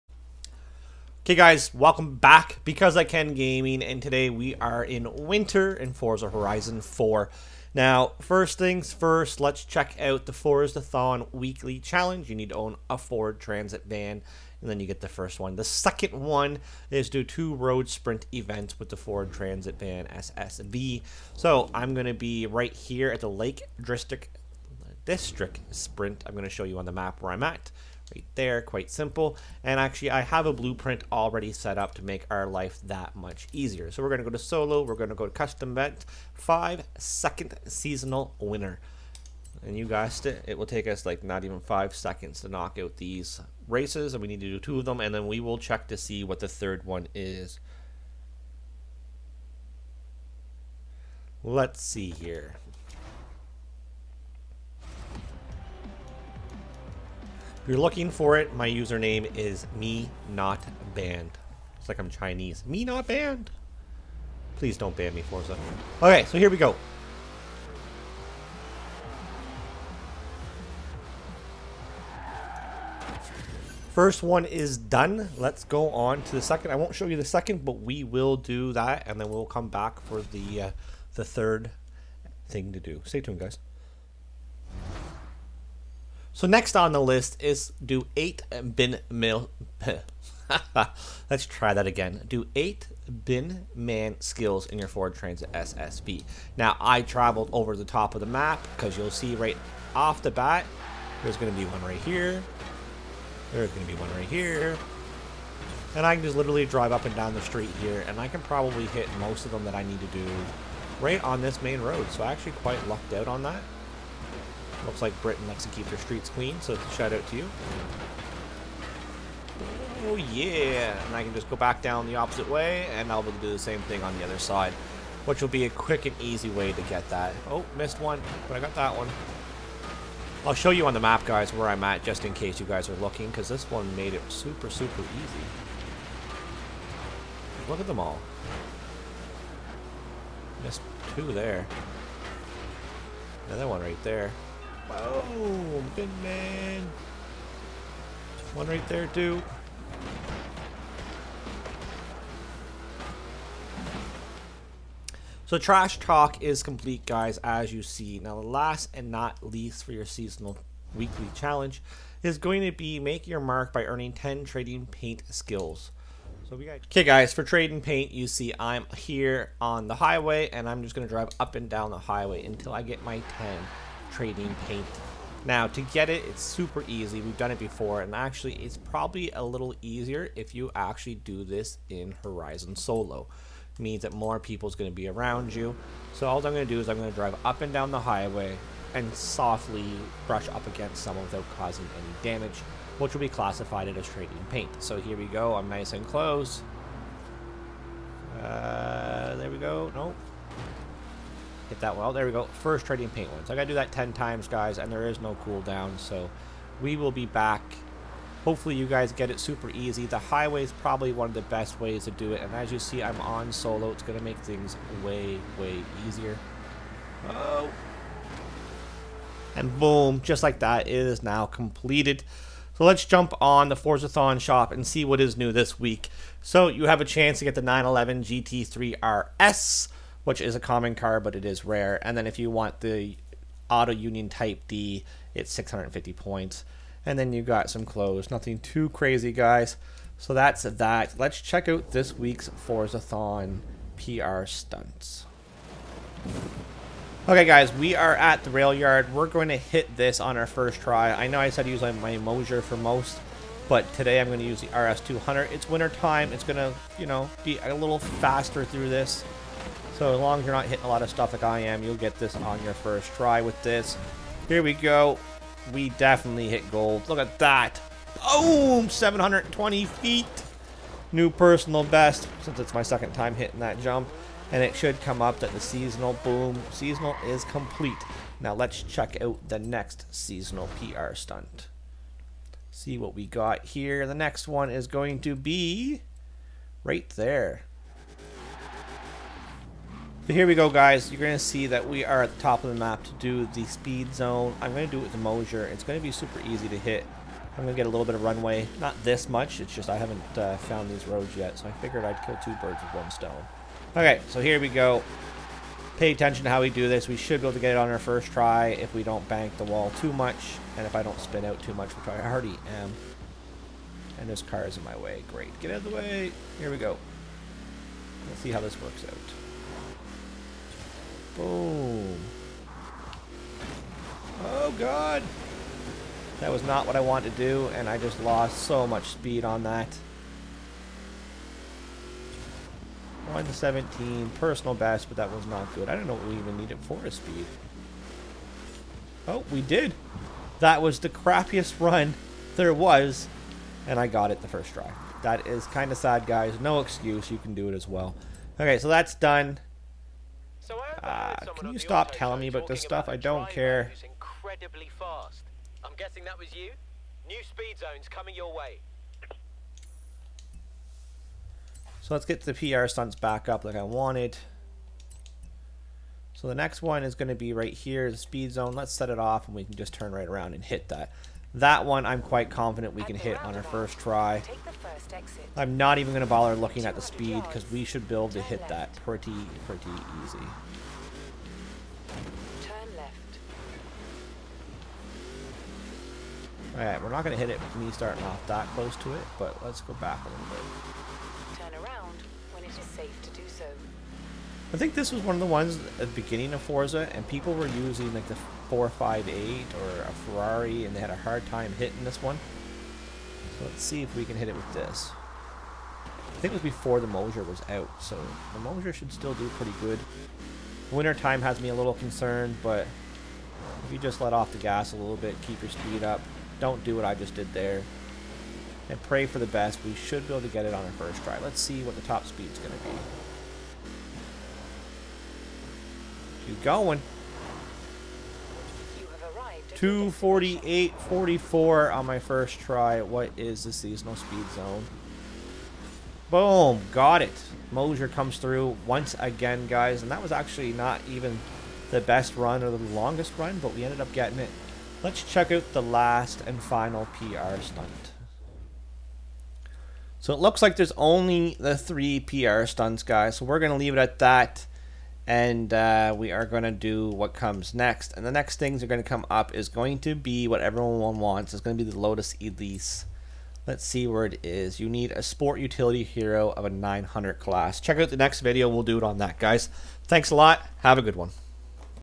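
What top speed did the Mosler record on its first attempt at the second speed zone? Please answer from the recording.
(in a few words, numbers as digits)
248.44.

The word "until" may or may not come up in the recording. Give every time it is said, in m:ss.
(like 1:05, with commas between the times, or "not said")
2:52.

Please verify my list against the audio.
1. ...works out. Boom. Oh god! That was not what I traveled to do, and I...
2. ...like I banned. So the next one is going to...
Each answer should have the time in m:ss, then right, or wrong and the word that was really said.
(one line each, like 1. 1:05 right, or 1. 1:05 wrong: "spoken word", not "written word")
1. 5:18 wrong: "wanted", not "traveled"
2. 6:03 wrong: "wanted", not "banned".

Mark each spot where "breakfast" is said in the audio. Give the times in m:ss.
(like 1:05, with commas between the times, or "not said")
not said.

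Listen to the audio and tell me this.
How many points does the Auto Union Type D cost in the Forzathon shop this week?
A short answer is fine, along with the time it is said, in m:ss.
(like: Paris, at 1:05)
650, at 3:55.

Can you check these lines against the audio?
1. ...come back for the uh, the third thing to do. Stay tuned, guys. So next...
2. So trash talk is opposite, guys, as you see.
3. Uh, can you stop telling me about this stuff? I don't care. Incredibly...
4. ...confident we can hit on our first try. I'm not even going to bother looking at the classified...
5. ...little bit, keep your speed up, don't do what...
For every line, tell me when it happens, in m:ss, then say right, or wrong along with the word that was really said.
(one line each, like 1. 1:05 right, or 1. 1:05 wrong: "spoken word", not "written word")
1. 1:19 right
2. 2:35 wrong: "complete", not "opposite"
3. 5:51 right
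4. 6:12 wrong: "speed", not "classified"
5. 6:54 right.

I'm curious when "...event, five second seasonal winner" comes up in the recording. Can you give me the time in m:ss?
0:35.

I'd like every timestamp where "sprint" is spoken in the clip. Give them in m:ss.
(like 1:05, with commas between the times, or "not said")
0:17, 0:25.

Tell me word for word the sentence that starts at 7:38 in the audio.
And the next things are going to come up is going to be what everyone wants.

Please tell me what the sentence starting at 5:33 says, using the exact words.
117 personal best, but that was not good.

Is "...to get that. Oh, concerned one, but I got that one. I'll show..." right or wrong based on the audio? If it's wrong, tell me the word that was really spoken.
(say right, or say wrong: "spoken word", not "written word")
wrong: "missed", not "concerned".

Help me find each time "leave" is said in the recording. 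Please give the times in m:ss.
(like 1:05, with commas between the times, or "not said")
7:33.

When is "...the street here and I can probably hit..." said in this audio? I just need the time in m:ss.
1:47.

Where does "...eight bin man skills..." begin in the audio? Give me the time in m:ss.
1:32.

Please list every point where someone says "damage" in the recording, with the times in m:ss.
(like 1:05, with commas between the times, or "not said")
3:12.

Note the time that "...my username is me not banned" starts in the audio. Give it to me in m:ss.
0:58.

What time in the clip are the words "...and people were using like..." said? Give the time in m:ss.
6:37.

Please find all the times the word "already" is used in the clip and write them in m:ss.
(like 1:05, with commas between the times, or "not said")
0:31, 5:12.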